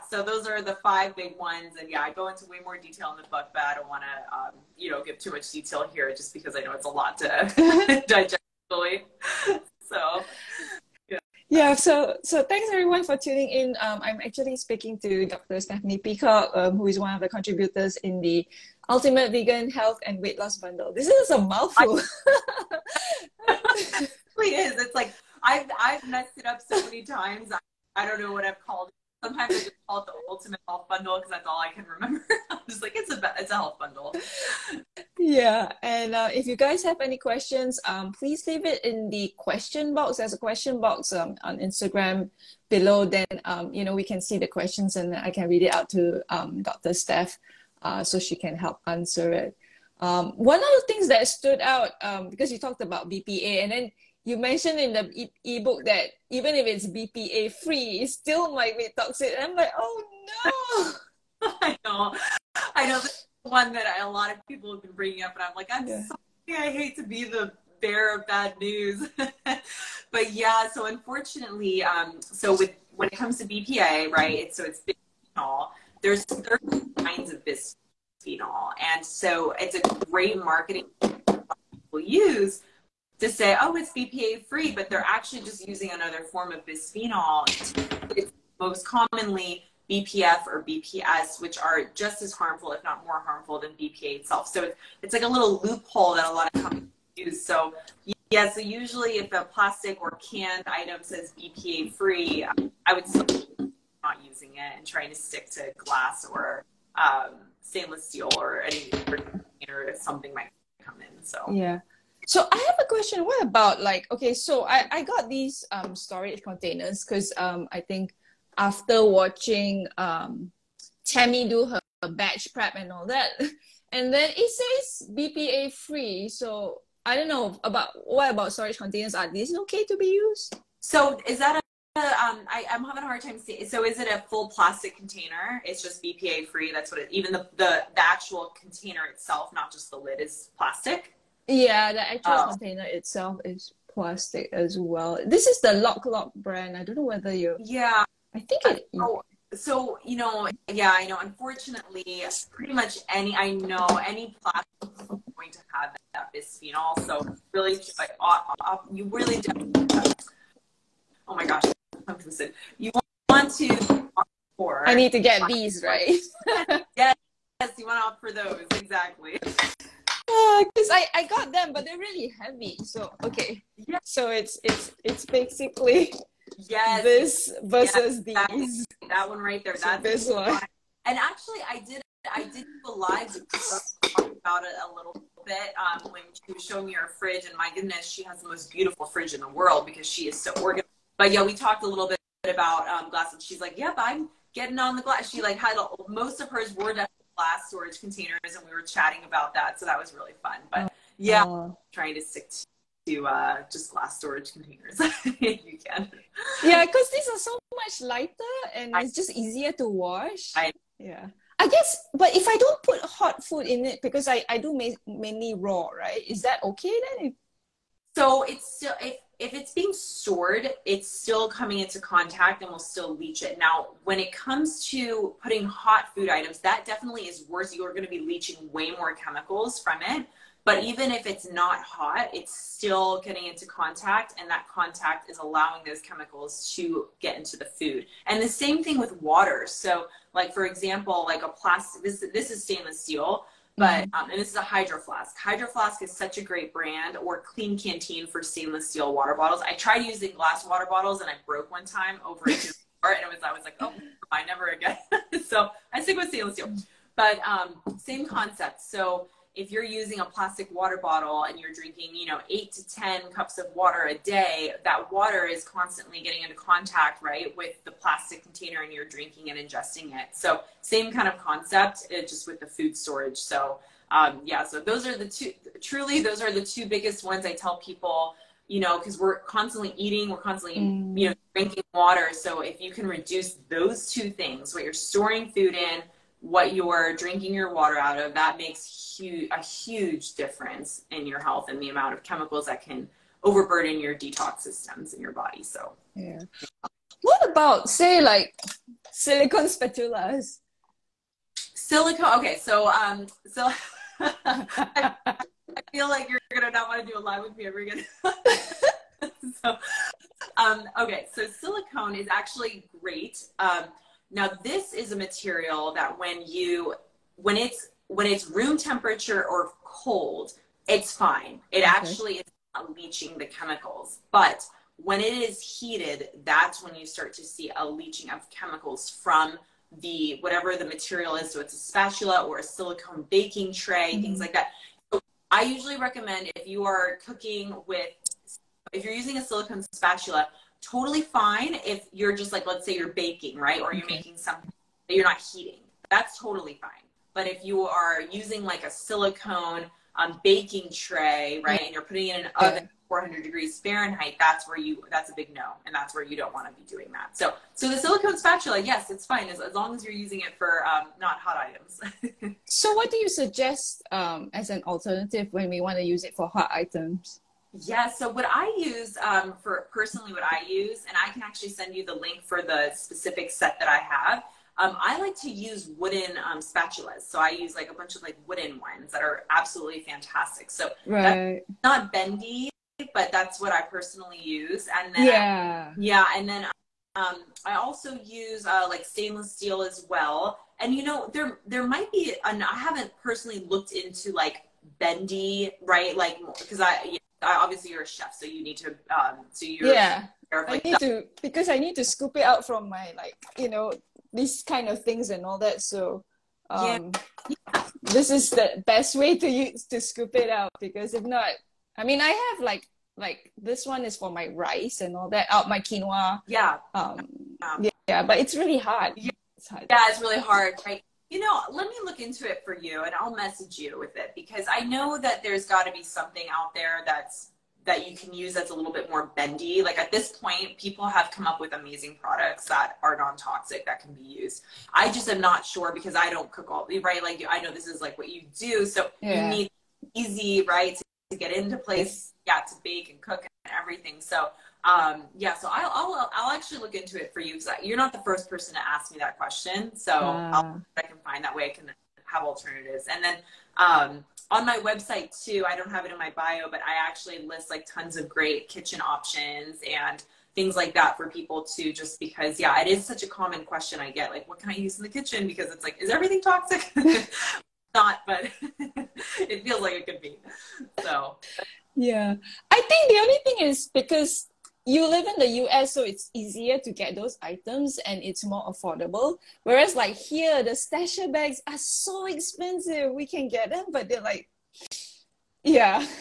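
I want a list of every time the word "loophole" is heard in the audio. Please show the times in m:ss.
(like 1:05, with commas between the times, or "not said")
1:35.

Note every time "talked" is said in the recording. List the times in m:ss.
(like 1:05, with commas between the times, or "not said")
0:52, 3:11.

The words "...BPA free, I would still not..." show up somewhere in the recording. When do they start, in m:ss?
1:41.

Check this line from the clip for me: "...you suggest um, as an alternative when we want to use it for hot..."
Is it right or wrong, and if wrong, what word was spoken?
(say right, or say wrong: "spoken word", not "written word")
right.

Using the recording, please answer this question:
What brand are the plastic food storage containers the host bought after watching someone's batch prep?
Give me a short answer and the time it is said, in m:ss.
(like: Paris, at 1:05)
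Lock Lock, at 2:25.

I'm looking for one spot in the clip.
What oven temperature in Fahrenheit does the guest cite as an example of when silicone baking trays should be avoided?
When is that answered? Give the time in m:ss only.
5:53.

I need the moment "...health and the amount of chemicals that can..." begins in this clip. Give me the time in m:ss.
4:51.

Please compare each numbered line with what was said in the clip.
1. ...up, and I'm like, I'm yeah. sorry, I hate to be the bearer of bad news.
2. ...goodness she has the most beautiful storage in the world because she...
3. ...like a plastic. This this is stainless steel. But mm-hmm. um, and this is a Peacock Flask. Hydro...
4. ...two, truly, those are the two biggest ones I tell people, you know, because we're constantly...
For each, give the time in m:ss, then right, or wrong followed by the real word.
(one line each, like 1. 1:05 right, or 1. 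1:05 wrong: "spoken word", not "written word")
1. 1:05 right
2. 3:07 wrong: "fridge", not "storage"
3. 4:01 wrong: "Hydro", not "Peacock"
4. 4:35 right.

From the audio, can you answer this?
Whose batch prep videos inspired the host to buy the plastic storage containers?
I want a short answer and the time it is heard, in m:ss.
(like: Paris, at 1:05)
Tammy, at 2:01.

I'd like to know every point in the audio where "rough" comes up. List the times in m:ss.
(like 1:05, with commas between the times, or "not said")
not said.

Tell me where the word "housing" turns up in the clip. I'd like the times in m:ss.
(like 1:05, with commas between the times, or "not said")
not said.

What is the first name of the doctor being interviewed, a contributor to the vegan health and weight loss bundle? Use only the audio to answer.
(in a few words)
Stephanie.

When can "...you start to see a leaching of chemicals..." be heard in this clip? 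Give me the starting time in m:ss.
5:26.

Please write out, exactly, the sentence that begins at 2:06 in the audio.
So I don't know about what about storage containers?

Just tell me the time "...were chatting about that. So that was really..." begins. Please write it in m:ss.
3:18.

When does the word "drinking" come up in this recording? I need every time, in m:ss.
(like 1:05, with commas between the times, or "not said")
4:21, 4:29, 4:41, 4:47.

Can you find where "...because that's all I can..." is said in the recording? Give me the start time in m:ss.
0:31.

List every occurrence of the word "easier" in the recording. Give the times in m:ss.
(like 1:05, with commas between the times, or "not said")
3:29, 7:56.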